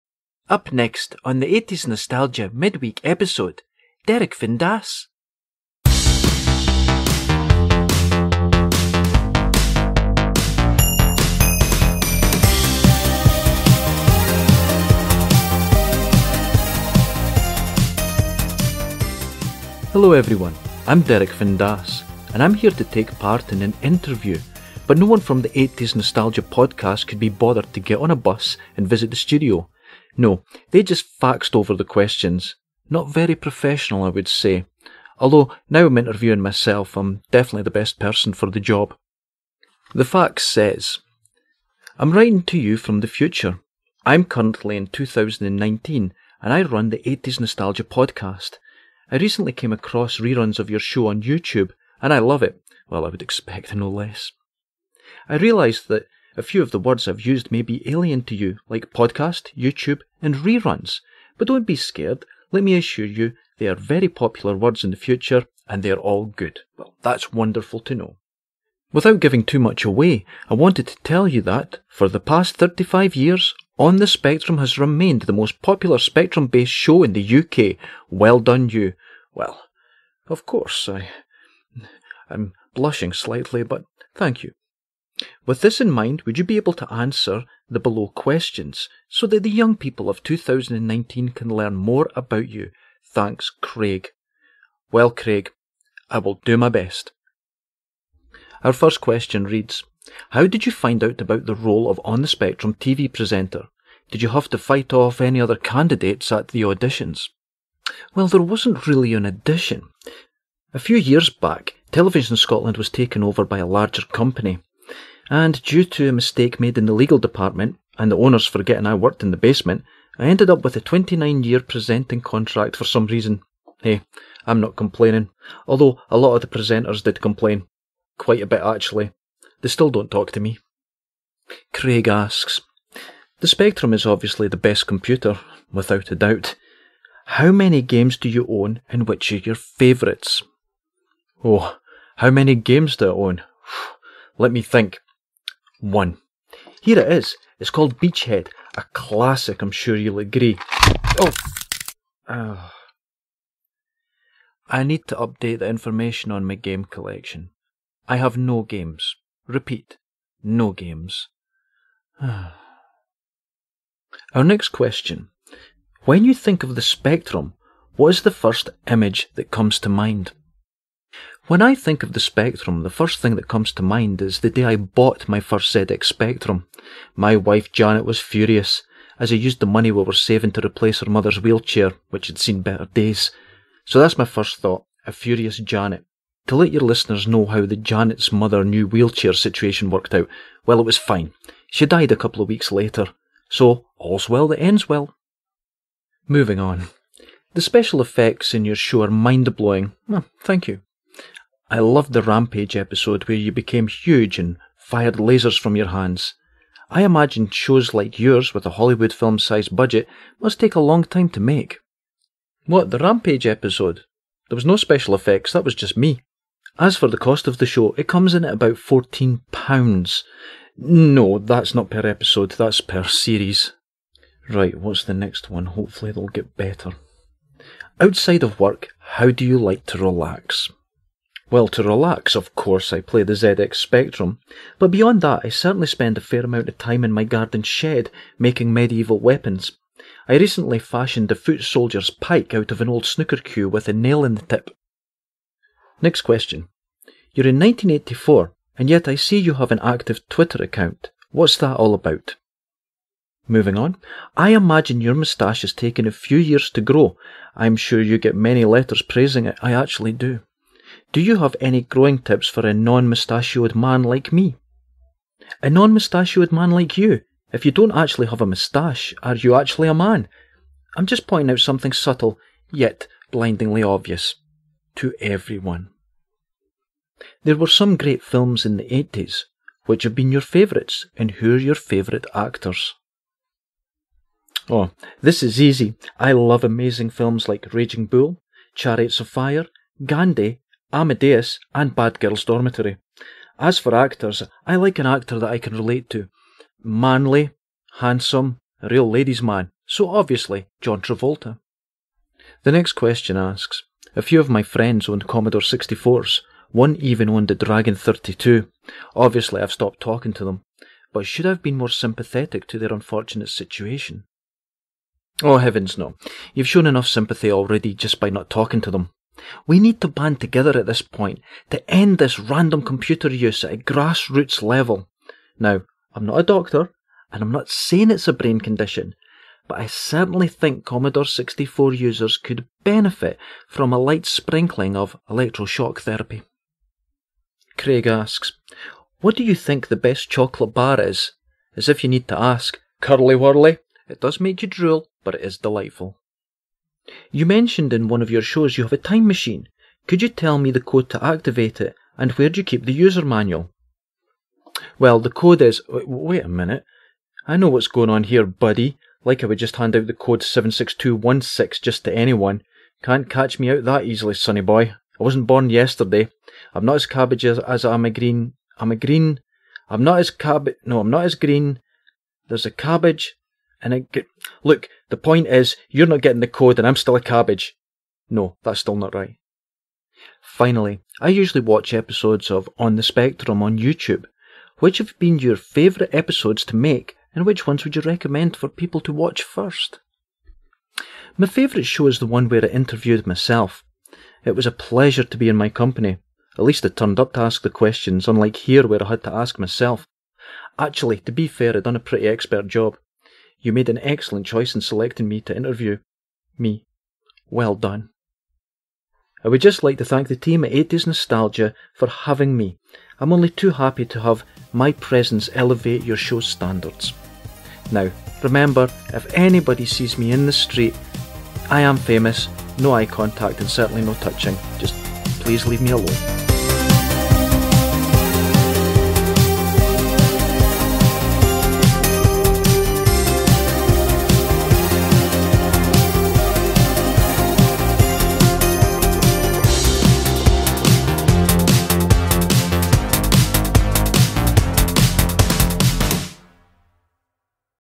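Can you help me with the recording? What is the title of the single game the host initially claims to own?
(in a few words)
Beachhead.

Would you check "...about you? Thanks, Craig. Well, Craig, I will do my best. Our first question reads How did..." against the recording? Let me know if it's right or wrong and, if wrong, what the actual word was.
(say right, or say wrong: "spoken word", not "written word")
right.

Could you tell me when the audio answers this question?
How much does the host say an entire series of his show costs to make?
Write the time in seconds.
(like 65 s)
218 s.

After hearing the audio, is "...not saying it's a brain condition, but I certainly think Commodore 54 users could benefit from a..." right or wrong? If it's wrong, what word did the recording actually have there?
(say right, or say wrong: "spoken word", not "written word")
wrong: "64", not "54".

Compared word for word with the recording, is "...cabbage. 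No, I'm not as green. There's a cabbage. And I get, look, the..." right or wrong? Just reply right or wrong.
right.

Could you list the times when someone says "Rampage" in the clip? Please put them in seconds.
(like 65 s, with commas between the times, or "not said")
202 s, 212 s.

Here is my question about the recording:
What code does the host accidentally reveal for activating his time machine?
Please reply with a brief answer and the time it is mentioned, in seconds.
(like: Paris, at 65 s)
76216, at 360 s.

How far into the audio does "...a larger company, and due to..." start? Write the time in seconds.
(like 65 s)
113 s.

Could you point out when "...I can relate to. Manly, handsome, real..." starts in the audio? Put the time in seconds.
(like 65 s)
295 s.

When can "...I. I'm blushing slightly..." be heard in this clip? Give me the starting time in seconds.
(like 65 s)
80 s.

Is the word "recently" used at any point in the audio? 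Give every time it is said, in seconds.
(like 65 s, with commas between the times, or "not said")
49 s, 240 s.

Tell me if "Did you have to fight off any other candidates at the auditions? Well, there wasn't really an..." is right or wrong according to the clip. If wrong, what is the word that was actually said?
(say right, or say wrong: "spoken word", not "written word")
right.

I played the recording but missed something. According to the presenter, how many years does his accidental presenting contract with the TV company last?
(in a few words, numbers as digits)
29.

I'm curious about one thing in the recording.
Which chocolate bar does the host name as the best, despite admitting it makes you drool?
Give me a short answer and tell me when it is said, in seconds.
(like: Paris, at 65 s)
Curly Wurly, at 342 s.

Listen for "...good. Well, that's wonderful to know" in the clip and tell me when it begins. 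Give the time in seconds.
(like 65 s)
66 s.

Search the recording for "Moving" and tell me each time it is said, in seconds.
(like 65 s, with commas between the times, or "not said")
196 s, 253 s.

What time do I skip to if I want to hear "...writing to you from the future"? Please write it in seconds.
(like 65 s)
42 s.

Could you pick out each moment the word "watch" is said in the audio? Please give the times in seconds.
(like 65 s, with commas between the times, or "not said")
381 s, 389 s.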